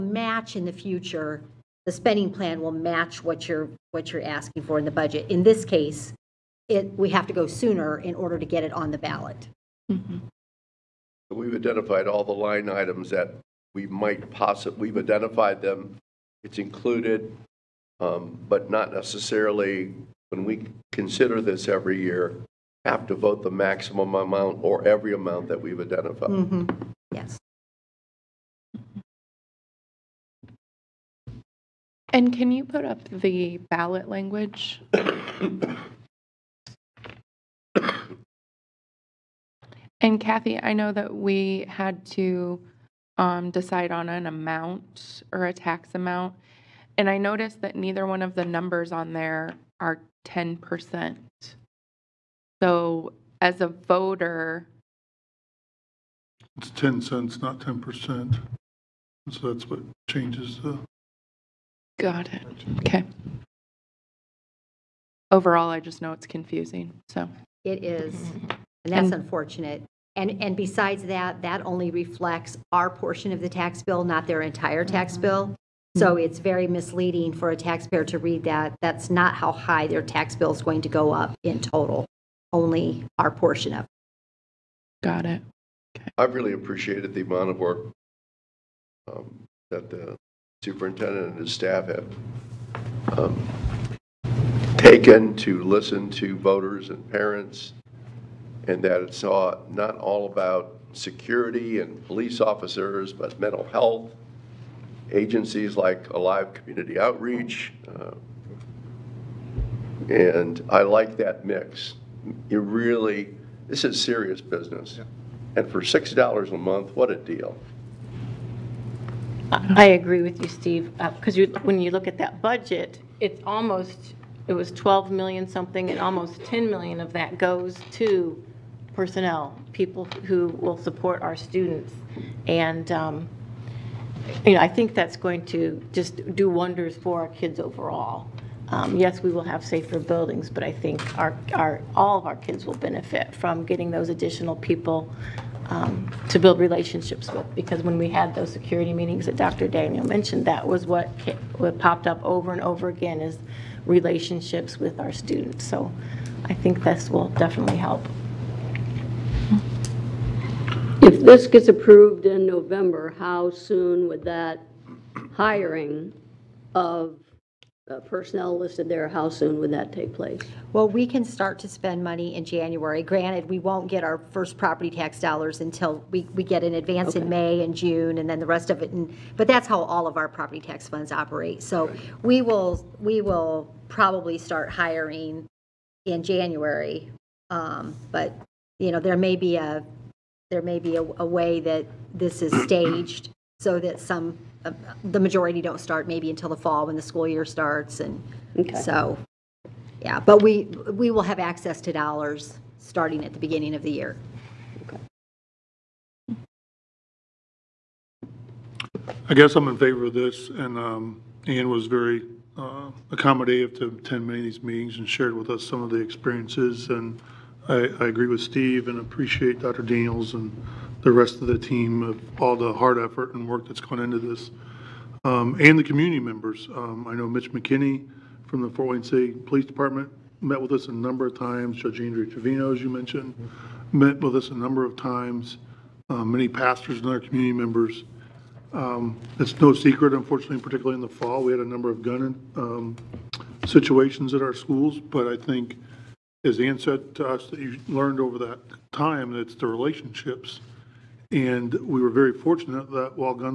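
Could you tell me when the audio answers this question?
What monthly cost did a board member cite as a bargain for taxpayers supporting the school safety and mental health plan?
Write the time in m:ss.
1:55.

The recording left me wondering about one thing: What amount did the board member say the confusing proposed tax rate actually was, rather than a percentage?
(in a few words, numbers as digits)
10 cents.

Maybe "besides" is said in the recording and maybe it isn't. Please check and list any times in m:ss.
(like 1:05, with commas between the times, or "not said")
1:10.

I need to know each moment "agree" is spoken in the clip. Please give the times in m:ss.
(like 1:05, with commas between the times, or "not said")
1:59, 3:38.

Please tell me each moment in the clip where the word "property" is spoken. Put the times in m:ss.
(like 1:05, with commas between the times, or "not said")
2:54, 3:00.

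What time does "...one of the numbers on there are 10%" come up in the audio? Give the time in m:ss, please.
0:48.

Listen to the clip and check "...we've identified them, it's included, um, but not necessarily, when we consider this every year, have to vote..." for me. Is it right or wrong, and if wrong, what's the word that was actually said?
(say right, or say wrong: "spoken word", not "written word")
right.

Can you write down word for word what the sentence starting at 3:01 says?
So we will, we will probably start hiring in January.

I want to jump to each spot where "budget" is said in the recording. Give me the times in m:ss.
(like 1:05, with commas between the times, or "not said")
0:04, 2:02.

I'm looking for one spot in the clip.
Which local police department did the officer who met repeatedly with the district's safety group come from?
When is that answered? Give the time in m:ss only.
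3:48.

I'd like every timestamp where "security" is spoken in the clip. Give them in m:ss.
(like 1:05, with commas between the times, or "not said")
1:40, 2:28.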